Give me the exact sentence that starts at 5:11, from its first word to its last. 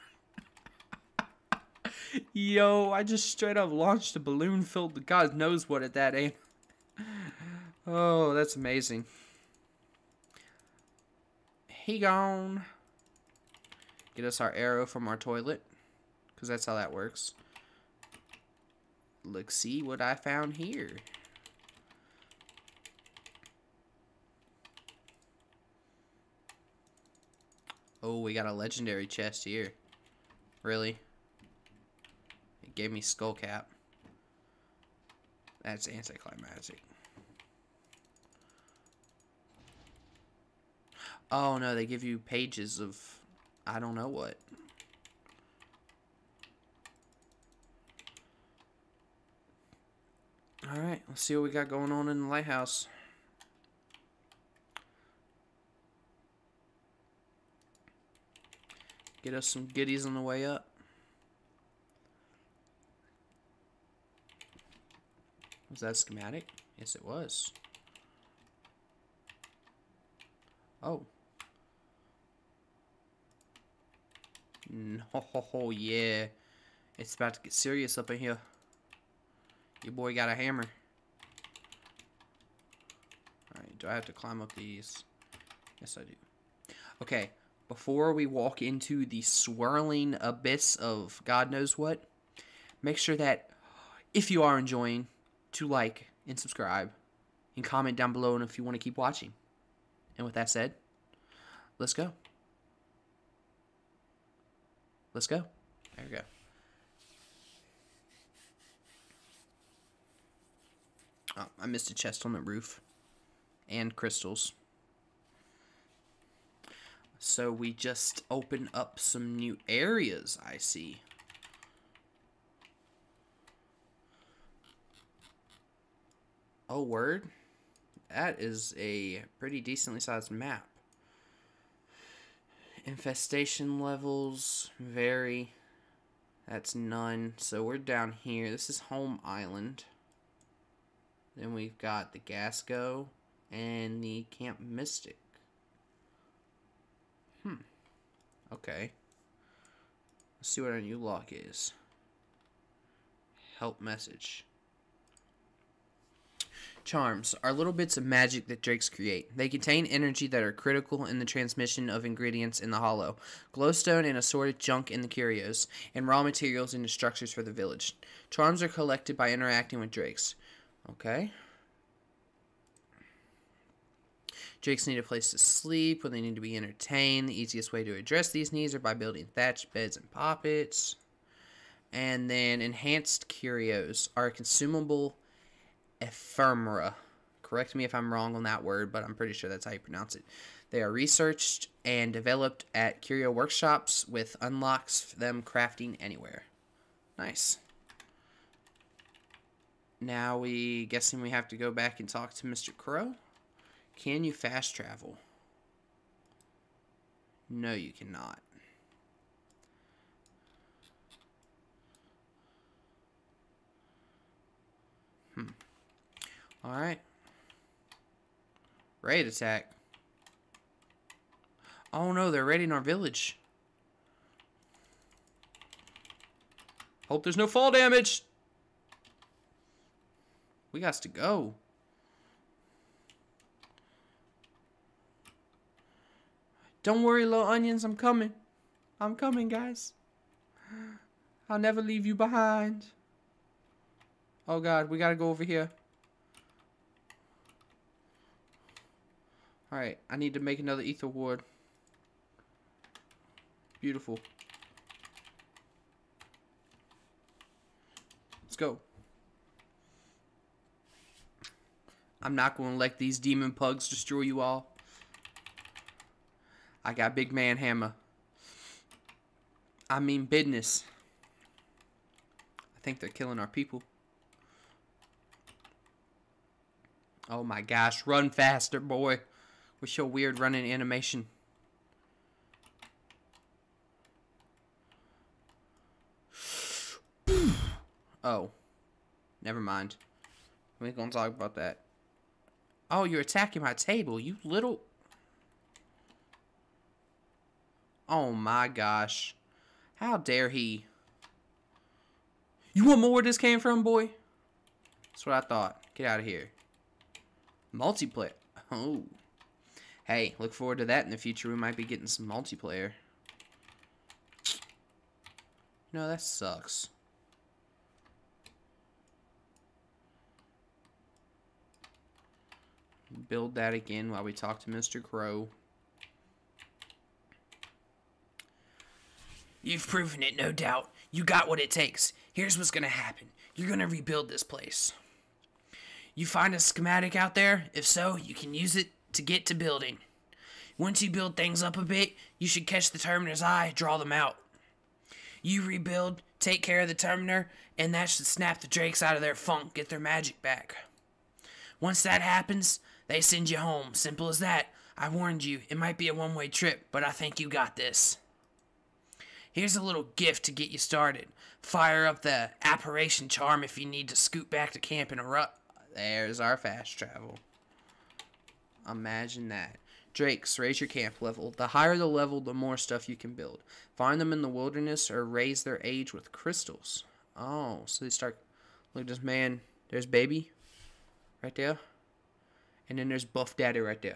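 We might be getting some multiplayer.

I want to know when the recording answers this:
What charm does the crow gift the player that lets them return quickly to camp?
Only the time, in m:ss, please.
6:02.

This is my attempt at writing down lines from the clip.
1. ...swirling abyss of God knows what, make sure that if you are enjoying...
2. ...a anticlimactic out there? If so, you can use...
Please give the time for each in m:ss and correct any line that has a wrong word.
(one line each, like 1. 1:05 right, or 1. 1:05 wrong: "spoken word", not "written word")
1. 1:29 right
2. 5:36 wrong: "schematic", not "anticlimactic".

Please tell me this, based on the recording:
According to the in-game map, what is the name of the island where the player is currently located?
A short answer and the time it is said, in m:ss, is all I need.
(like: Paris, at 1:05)
Home Island, at 2:18.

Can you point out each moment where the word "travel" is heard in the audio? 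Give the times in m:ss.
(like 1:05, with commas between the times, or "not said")
3:24, 6:06.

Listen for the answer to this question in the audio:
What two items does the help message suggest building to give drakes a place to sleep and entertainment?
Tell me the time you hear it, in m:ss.
2:59.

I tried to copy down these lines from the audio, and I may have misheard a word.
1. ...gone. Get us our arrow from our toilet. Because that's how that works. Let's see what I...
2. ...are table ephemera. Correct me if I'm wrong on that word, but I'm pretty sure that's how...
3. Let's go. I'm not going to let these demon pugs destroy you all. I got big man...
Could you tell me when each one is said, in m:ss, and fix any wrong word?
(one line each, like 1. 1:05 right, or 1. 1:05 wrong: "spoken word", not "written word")
1. 0:11 right
2. 3:04 wrong: "consumable", not "table"
3. 4:18 right.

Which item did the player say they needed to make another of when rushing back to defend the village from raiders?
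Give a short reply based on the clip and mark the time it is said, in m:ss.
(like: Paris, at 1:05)
Ether ward, at 4:10.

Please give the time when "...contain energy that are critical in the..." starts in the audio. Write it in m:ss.
2:39.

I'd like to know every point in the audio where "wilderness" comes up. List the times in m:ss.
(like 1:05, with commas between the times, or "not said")
6:14.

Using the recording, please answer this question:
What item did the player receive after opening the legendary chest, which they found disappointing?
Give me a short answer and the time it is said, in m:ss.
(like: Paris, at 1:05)
Skull cap, at 0:32.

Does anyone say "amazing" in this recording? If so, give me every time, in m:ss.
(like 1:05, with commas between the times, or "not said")
0:08.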